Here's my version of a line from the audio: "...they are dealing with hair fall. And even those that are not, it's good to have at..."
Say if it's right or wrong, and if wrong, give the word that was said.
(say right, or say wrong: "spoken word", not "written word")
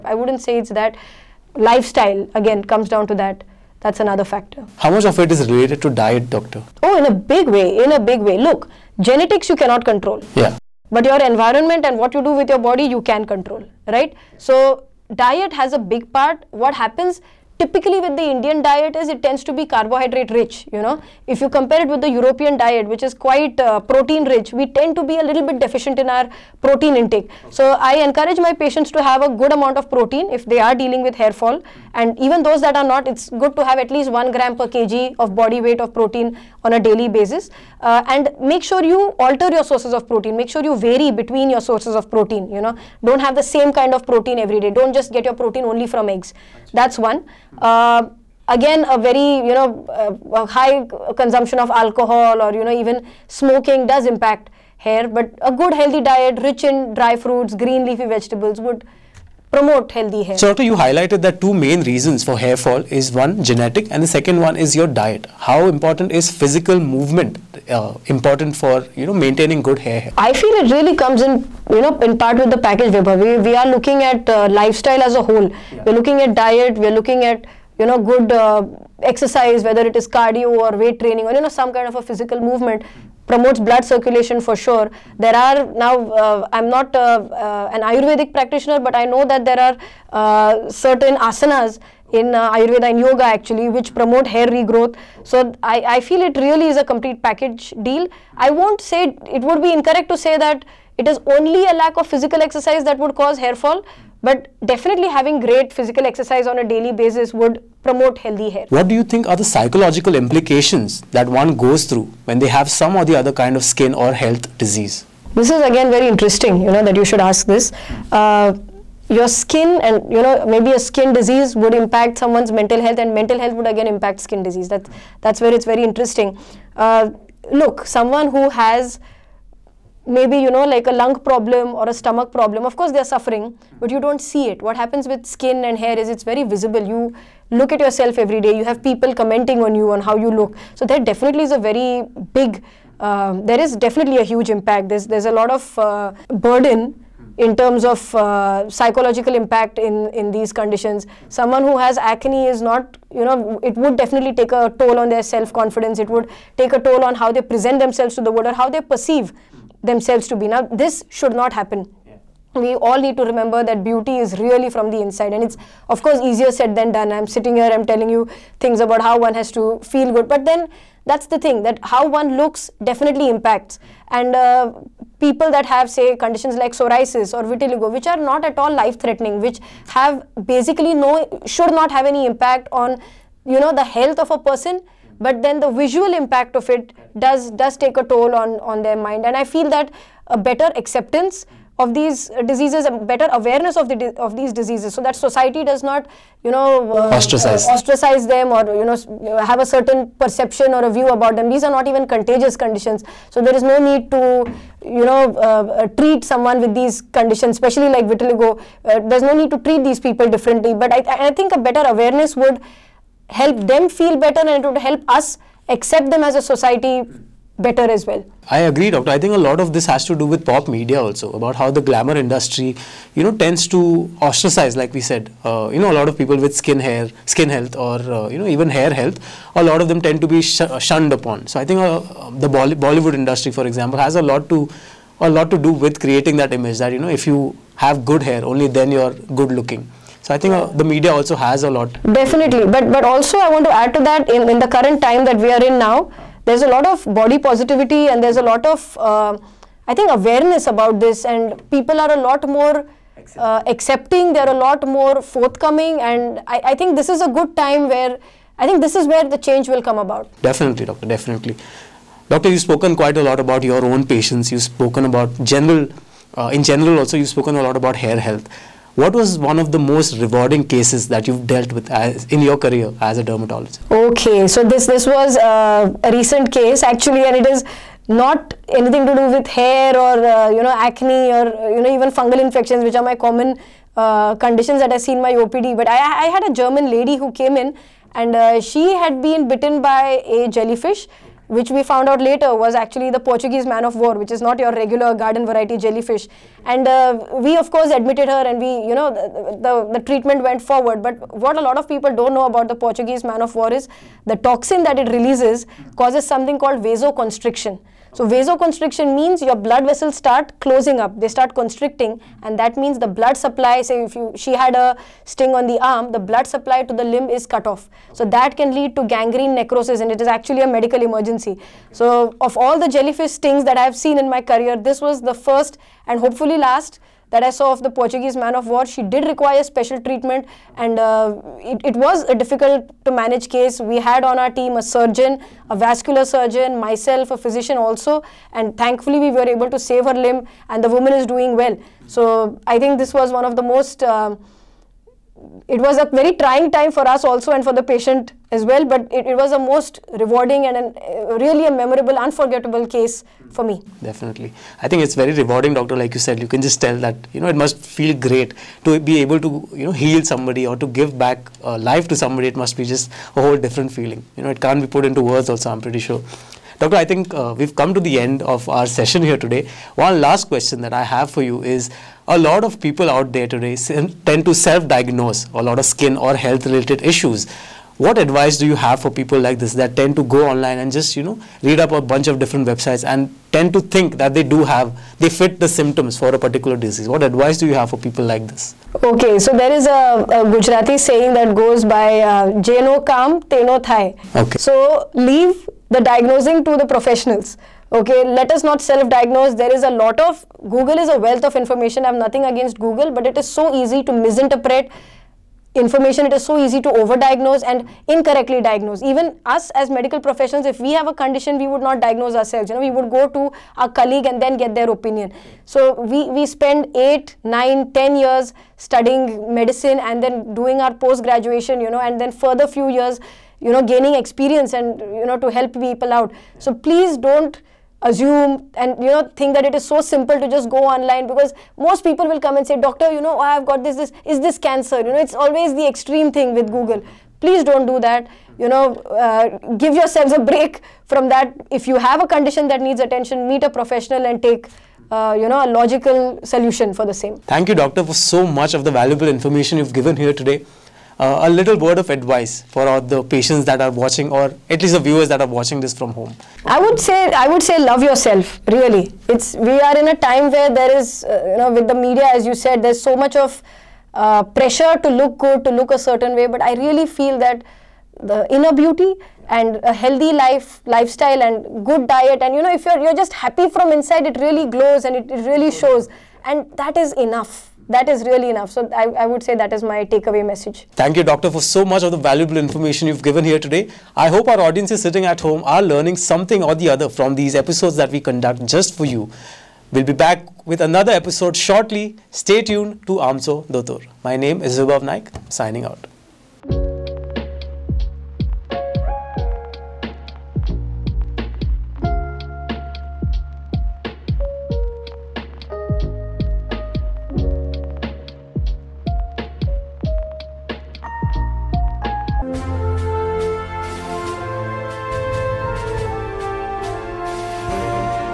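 right.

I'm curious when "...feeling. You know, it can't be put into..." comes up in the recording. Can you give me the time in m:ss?
6:03.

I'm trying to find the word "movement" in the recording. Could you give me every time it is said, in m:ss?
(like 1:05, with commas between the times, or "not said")
1:06, 1:22.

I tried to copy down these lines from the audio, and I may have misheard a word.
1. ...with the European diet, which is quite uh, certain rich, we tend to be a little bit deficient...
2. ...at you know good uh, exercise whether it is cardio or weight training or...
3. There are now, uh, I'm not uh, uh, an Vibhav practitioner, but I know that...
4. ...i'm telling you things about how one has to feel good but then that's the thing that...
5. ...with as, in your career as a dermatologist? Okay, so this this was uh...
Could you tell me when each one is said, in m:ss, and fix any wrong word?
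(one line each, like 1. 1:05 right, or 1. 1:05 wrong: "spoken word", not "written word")
1. 0:21 wrong: "protein", not "certain"
2. 1:17 right
3. 1:25 wrong: "Ayurvedic", not "Vibhav"
4. 2:47 right
5. 4:31 right.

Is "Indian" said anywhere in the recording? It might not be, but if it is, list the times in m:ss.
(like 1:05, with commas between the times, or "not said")
0:18.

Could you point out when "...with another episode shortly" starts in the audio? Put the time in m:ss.
8:10.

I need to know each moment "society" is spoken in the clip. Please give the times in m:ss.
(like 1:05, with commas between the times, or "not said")
3:15, 3:36.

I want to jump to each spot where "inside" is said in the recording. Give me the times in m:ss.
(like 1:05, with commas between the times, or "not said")
2:44, 7:53.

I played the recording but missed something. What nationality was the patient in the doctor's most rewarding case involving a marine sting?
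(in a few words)
German.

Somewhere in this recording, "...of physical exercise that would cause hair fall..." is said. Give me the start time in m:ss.
1:41.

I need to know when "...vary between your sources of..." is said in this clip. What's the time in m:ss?
0:40.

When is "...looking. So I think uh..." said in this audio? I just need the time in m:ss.
3:59.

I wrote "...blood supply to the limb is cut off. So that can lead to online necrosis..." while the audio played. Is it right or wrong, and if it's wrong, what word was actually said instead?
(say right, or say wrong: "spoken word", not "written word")
wrong: "gangrene", not "online".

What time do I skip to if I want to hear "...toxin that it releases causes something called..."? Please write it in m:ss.
5:04.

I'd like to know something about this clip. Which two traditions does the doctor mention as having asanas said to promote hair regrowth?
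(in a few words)
Ayurveda and yoga.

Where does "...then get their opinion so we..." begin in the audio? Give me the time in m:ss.
6:54.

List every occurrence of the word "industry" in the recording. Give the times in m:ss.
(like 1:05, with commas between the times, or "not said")
3:42, 3:53.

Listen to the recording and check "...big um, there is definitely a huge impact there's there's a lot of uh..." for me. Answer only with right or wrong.
right.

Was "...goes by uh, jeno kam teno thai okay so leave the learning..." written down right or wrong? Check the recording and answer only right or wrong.
wrong.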